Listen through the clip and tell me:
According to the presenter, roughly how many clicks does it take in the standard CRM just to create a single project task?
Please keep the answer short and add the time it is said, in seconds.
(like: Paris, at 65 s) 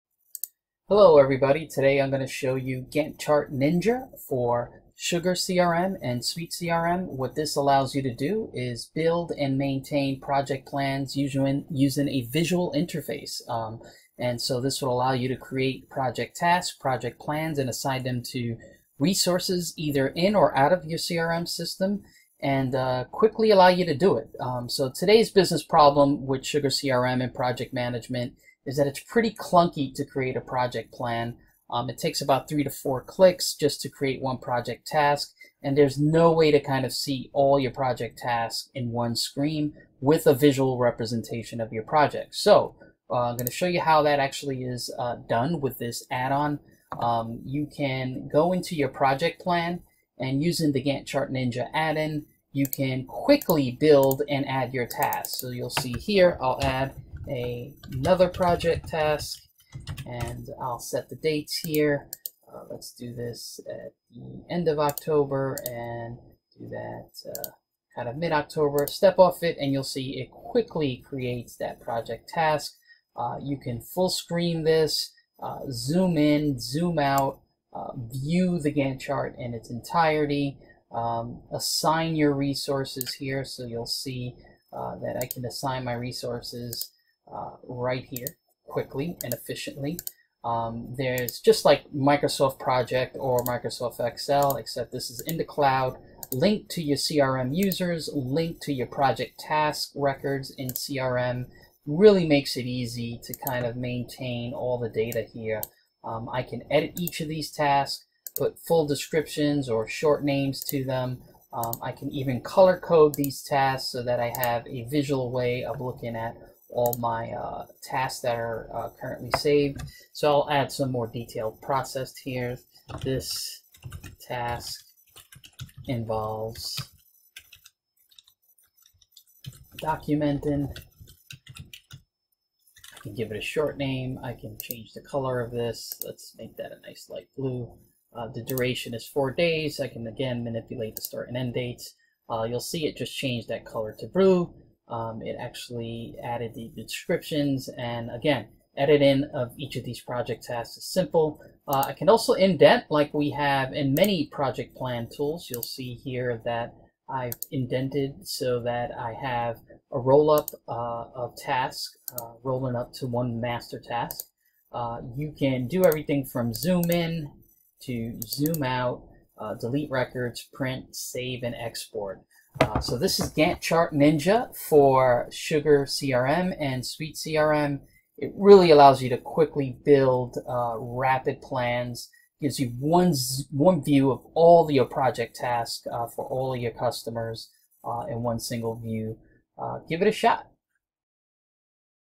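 3 to 4, at 32 s.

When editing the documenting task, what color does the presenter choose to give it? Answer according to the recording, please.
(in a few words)
Light blue.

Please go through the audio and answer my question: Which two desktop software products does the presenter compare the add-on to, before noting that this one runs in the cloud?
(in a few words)
Microsoft Project or Microsoft Excel.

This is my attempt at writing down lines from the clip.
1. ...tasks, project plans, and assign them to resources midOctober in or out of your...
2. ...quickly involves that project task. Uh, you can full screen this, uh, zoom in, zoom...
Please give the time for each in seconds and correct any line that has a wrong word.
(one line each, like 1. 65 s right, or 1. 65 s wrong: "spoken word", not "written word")
1. 16 s wrong: "either", not "midOctober"
2. 70 s wrong: "creates", not "involves".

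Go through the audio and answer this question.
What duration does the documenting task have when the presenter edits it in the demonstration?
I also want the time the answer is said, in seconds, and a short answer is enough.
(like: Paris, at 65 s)
4 days, at 139 s.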